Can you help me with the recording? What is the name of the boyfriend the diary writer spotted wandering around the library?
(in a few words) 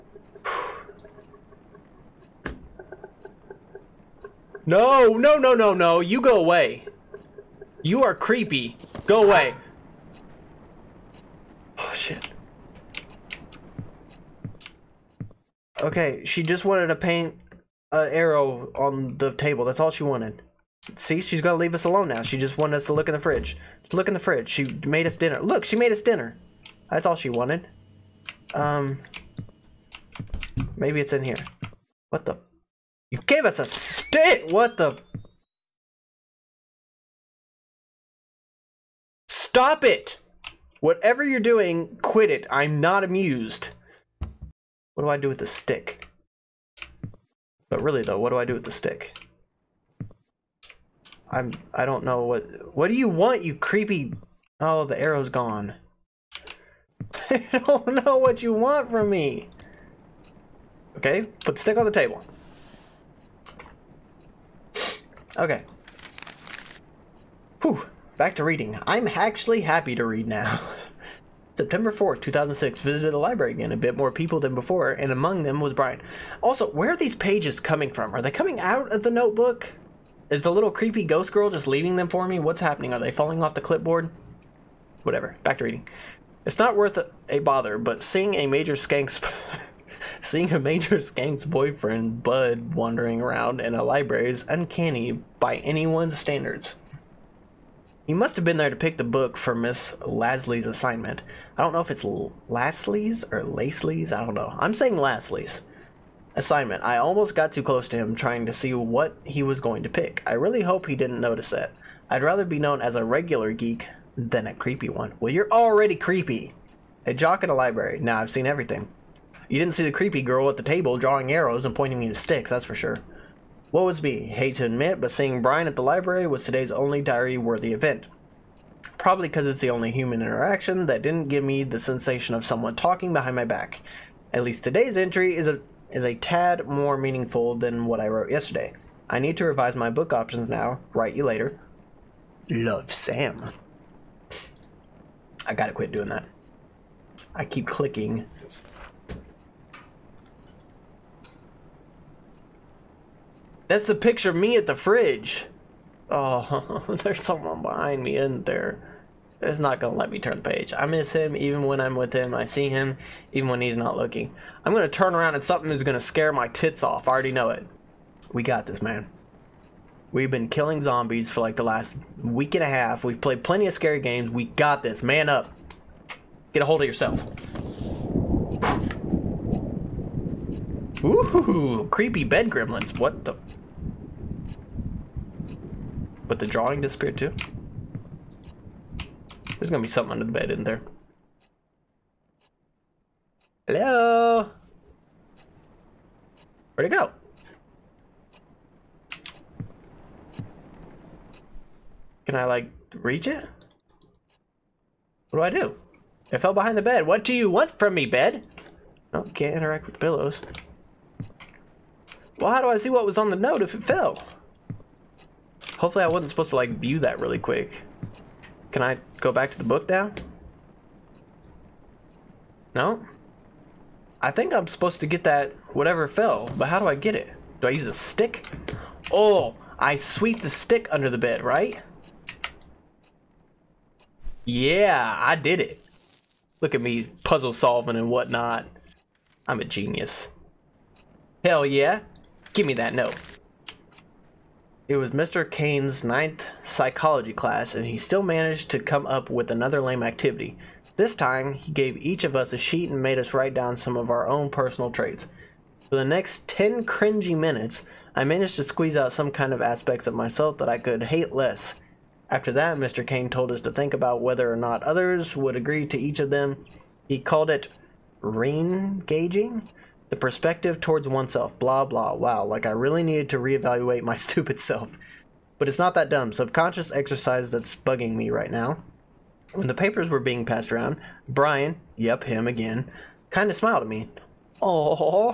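Bud.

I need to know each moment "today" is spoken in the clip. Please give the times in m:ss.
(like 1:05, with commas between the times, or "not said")
2:06, 2:14.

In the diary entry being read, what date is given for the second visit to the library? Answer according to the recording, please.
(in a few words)
September 4th, 2006.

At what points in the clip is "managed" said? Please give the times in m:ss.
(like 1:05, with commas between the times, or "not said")
4:08, 4:18.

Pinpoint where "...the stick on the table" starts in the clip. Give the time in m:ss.
1:01.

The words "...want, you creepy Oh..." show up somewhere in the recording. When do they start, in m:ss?
0:53.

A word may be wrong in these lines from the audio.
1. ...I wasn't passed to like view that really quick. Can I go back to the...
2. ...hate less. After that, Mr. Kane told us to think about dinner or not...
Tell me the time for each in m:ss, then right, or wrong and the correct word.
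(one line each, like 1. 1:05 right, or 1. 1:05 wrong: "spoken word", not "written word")
1. 3:36 wrong: "supposed", not "passed"
2. 4:21 wrong: "whether", not "dinner".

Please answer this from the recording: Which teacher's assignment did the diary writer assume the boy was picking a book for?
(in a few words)
Miss Lasley.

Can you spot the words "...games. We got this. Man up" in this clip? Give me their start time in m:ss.
2:53.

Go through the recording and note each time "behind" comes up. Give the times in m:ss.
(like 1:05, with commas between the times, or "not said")
2:13, 2:37, 3:26.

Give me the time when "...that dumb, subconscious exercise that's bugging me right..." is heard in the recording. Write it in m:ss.
4:35.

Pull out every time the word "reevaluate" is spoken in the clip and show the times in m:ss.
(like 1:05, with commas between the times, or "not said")
4:33.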